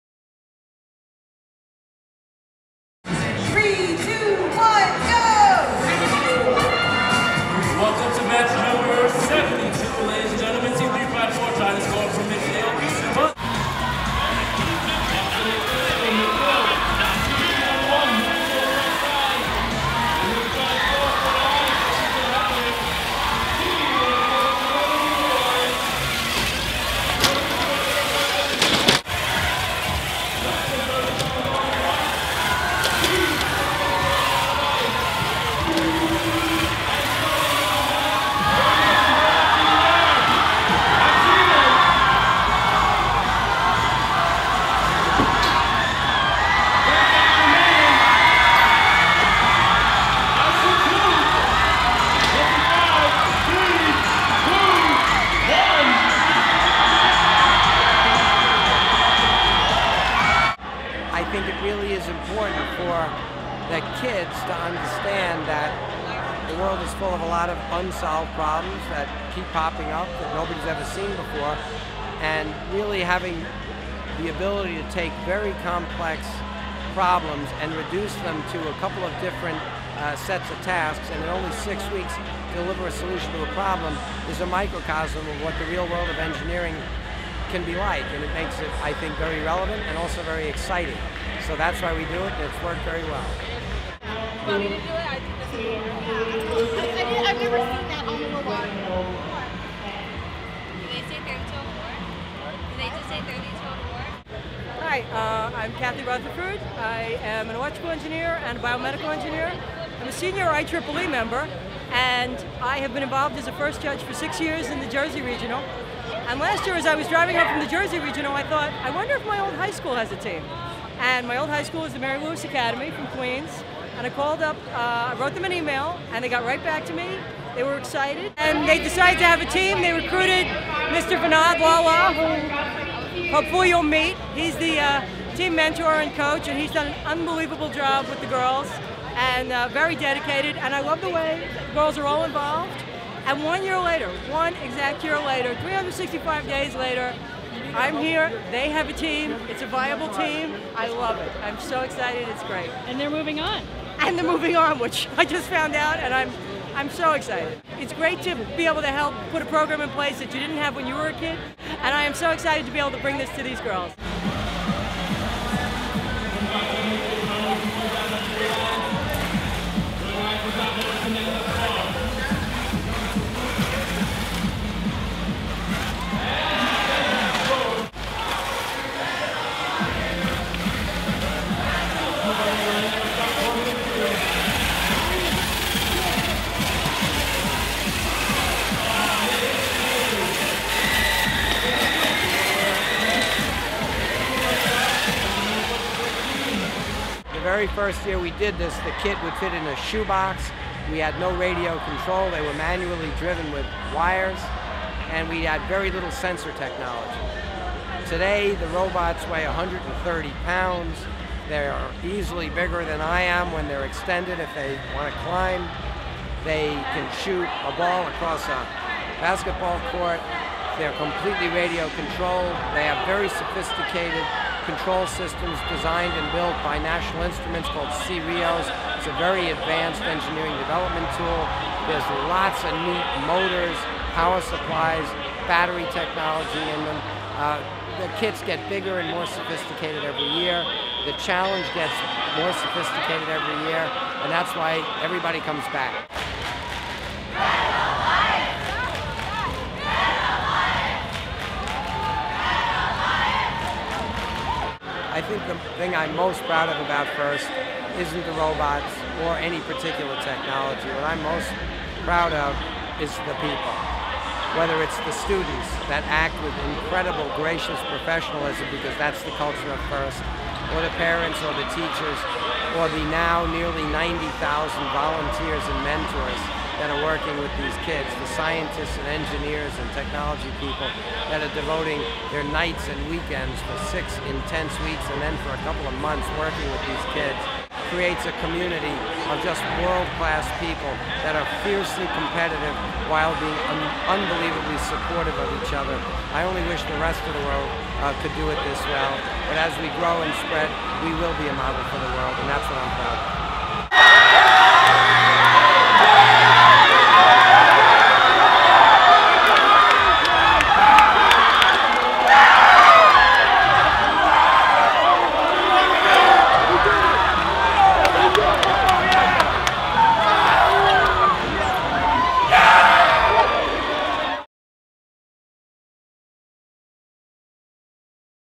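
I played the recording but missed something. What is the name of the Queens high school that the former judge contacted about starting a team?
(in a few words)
Mary Louis Academy.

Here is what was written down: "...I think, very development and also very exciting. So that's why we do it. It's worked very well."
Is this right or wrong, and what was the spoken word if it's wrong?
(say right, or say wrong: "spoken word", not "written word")
wrong: "relevant", not "development".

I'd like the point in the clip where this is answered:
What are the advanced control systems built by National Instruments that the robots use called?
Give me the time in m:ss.
3:48.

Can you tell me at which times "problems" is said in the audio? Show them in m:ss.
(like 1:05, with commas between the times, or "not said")
1:08, 1:16, 1:23.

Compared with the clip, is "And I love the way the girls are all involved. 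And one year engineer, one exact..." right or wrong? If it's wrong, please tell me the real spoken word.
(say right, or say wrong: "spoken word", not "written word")
wrong: "later", not "engineer".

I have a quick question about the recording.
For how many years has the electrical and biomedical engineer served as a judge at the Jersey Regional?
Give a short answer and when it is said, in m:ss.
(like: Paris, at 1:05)
6, at 1:54.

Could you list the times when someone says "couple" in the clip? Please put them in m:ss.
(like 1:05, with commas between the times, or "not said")
1:18, 4:45.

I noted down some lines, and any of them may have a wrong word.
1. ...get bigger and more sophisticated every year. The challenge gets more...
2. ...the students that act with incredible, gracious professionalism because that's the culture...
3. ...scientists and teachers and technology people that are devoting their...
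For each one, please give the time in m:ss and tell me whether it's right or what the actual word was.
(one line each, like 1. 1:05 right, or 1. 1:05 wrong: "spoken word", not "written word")
1. 3:58 right
2. 4:25 right
3. 4:38 wrong: "engineers", not "teachers".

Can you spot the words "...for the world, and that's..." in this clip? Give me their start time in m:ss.
5:01.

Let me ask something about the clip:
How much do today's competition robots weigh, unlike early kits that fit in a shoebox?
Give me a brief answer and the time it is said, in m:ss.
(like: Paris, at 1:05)
130 pounds, at 3:29.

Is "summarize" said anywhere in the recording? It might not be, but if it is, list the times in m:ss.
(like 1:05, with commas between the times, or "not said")
not said.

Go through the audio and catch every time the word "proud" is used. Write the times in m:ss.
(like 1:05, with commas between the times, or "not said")
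4:16, 4:22, 5:02.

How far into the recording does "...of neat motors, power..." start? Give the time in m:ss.
3:52.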